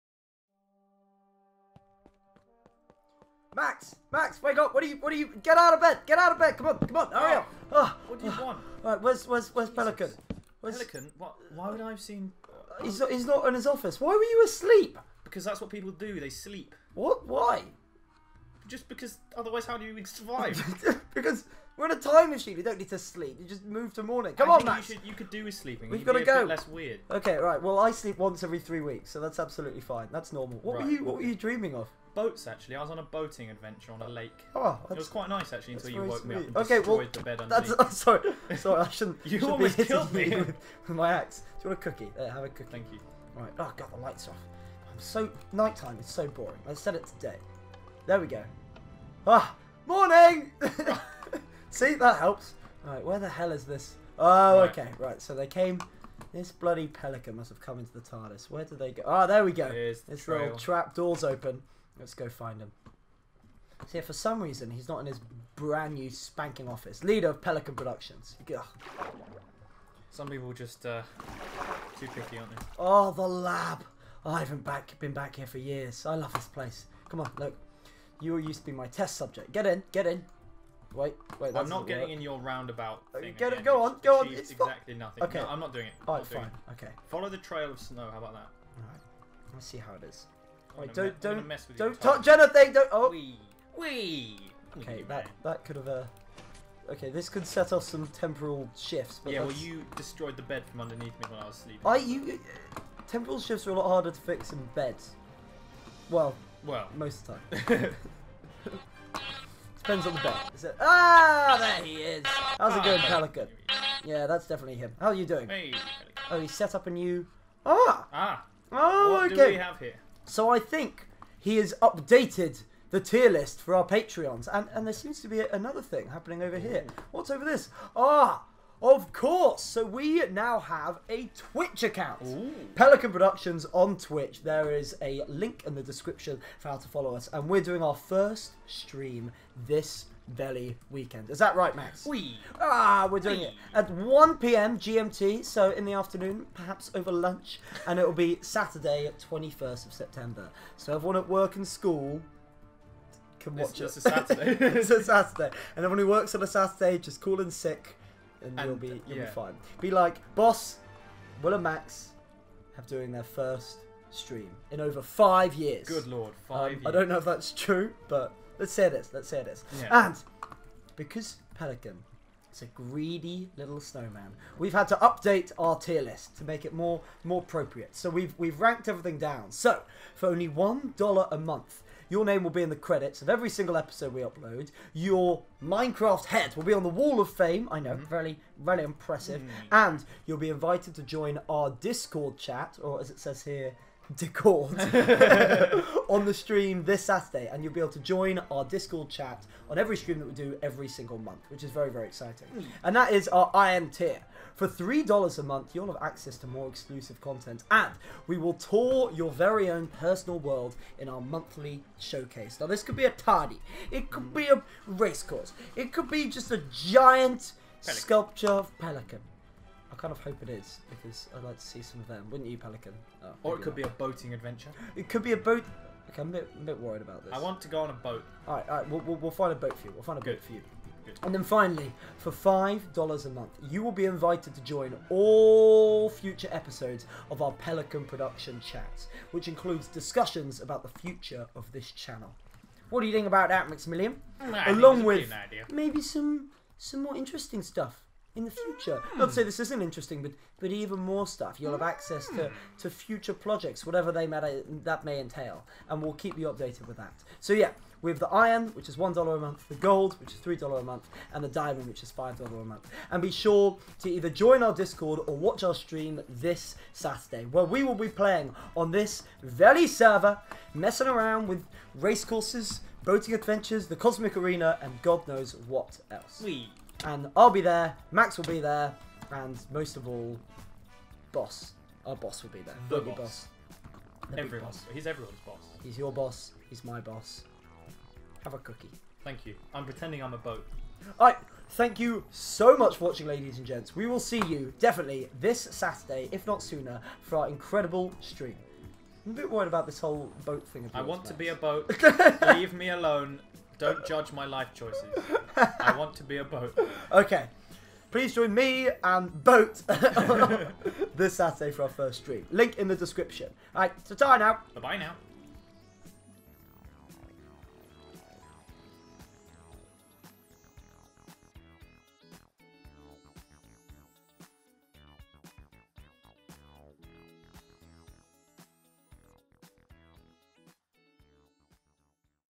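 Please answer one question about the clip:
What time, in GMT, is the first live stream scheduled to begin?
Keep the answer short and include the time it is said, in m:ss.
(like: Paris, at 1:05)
1 p.m., at 2:23.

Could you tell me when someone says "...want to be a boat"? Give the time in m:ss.
5:05.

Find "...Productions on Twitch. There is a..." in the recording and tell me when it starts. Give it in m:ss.
2:13.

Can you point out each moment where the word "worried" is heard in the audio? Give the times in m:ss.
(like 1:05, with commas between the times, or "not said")
3:46, 4:59.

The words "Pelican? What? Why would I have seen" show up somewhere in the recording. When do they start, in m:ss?
0:10.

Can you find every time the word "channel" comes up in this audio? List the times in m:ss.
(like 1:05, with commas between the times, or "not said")
4:01.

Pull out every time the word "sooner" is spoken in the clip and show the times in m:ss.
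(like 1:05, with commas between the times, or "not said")
4:56.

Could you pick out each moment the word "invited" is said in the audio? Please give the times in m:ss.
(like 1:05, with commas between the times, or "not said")
3:10, 3:54.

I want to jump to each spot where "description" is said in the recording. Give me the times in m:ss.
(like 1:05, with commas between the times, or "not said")
2:15, 5:12.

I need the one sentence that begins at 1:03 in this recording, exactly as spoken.
See, for some reason, he's not in his brand new spanking office.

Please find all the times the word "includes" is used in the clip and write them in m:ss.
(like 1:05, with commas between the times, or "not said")
3:59.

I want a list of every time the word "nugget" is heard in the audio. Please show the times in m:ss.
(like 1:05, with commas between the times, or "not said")
not said.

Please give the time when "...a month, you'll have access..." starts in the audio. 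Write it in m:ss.
3:25.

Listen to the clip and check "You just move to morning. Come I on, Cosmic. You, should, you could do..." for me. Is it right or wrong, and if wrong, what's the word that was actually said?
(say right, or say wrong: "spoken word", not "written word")
wrong: "Max", not "Cosmic".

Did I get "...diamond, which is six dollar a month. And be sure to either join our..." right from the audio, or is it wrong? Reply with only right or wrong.
wrong.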